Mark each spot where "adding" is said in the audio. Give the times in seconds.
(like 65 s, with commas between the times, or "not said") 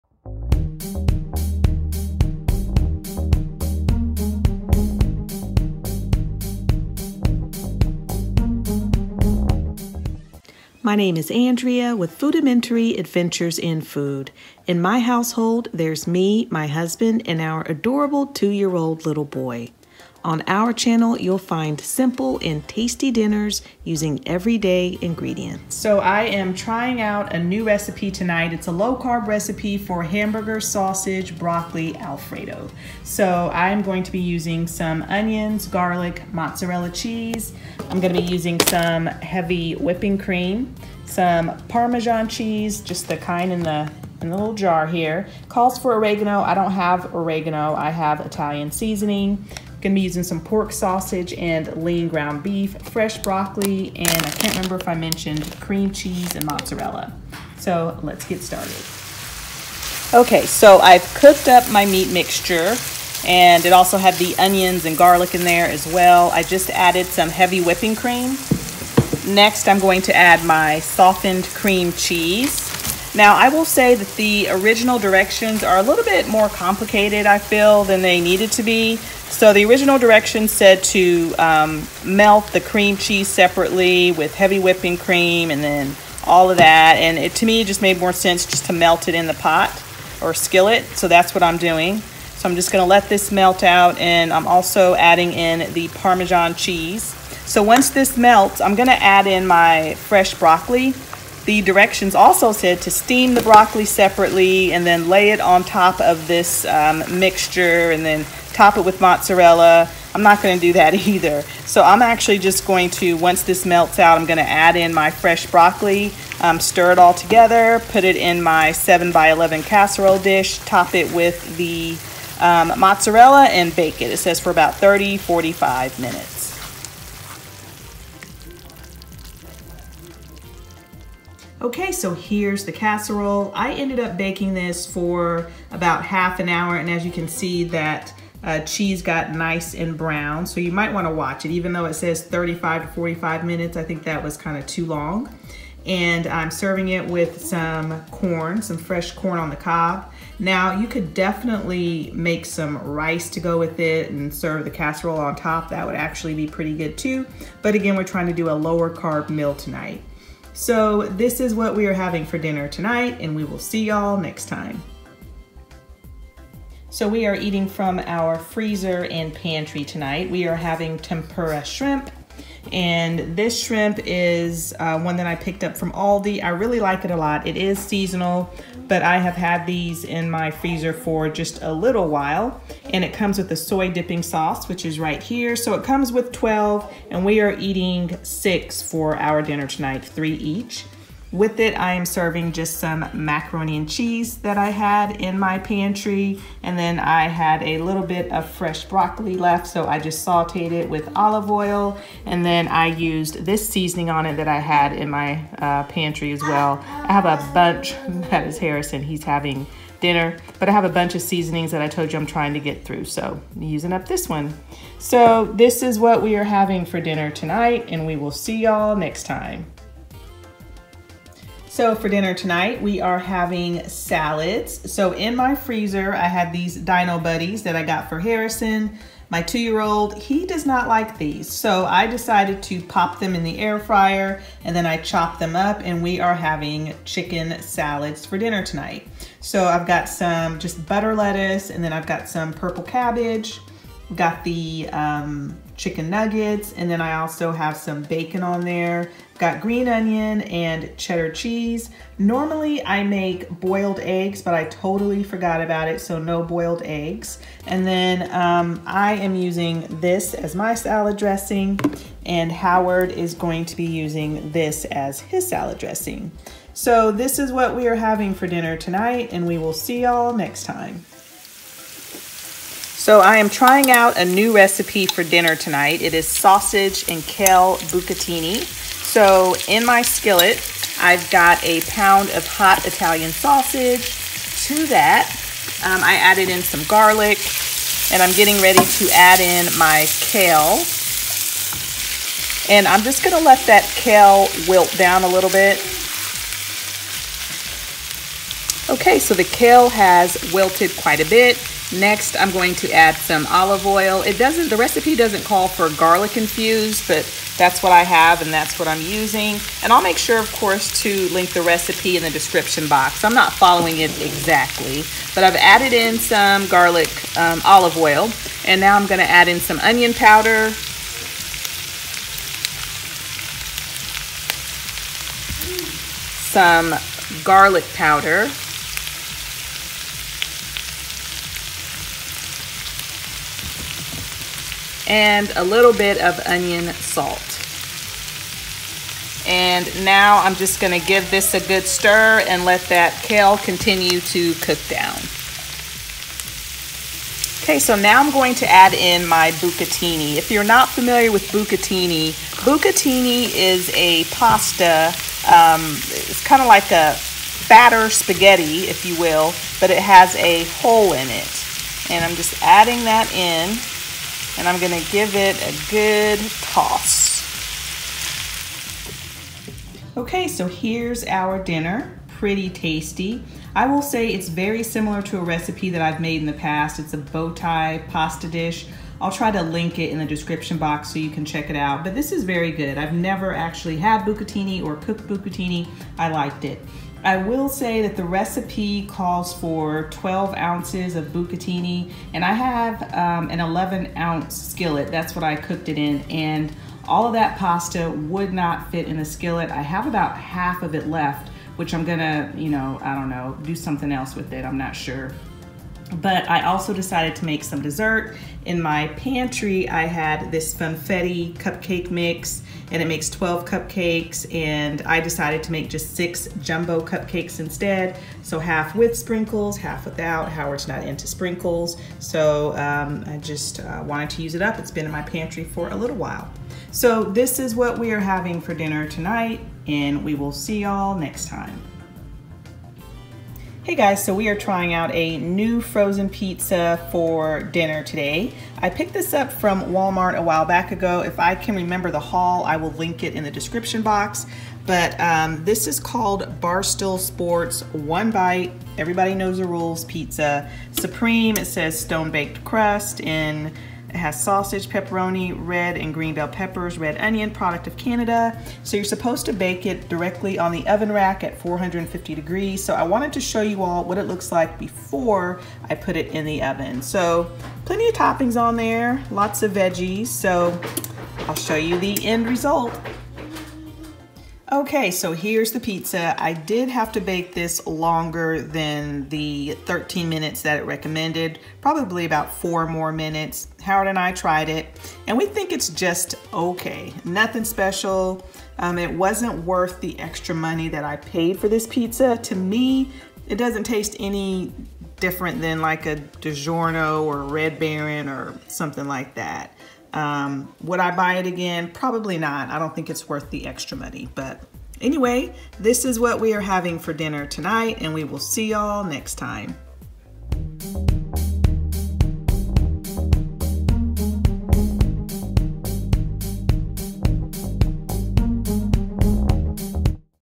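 94 s, 362 s.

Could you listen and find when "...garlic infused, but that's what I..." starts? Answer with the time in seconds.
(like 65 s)
305 s.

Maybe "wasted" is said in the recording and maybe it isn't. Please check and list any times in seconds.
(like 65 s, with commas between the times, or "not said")
not said.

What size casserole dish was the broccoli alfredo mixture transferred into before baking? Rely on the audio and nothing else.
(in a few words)
7 by 11.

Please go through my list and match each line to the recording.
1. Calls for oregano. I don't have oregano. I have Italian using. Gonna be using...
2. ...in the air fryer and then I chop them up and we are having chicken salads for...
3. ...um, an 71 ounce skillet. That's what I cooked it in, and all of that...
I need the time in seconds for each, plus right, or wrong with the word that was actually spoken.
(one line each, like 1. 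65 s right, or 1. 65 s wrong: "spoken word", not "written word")
1. 45 s wrong: "seasoning", not "using"
2. 233 s right
3. 393 s wrong: "11", not "71".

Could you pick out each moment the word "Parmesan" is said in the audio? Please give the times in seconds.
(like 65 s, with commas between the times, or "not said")
41 s, 95 s.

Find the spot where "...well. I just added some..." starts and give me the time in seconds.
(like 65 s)
65 s.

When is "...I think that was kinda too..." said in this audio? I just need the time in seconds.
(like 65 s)
143 s.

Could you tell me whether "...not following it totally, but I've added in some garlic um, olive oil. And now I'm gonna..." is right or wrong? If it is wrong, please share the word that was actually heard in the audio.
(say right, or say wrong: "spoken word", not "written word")
wrong: "exactly", not "totally".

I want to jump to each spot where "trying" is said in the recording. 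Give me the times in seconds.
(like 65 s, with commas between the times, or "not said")
26 s, 158 s, 212 s, 273 s, 434 s.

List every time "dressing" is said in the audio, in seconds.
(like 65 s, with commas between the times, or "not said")
261 s, 265 s.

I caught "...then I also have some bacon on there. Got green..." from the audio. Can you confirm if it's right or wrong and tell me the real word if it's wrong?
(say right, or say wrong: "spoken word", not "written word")
right.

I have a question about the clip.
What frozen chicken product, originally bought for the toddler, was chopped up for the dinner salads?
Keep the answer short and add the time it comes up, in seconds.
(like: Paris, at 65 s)
Dino Buddies, at 226 s.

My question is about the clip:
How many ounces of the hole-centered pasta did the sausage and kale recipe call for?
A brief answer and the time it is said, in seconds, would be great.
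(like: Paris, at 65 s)
12, at 390 s.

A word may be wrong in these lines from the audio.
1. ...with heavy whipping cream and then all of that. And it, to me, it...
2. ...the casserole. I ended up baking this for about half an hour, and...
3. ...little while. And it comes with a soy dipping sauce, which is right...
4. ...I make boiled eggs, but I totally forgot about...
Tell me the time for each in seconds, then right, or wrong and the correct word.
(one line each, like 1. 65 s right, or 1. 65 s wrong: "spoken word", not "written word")
1. 84 s right
2. 132 s right
3. 181 s right
4. 252 s right.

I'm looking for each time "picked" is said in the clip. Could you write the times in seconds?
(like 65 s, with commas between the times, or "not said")
175 s, 438 s.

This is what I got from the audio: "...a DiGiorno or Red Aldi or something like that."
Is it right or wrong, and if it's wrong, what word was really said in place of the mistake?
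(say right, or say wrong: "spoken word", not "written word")
wrong: "Baron", not "Aldi".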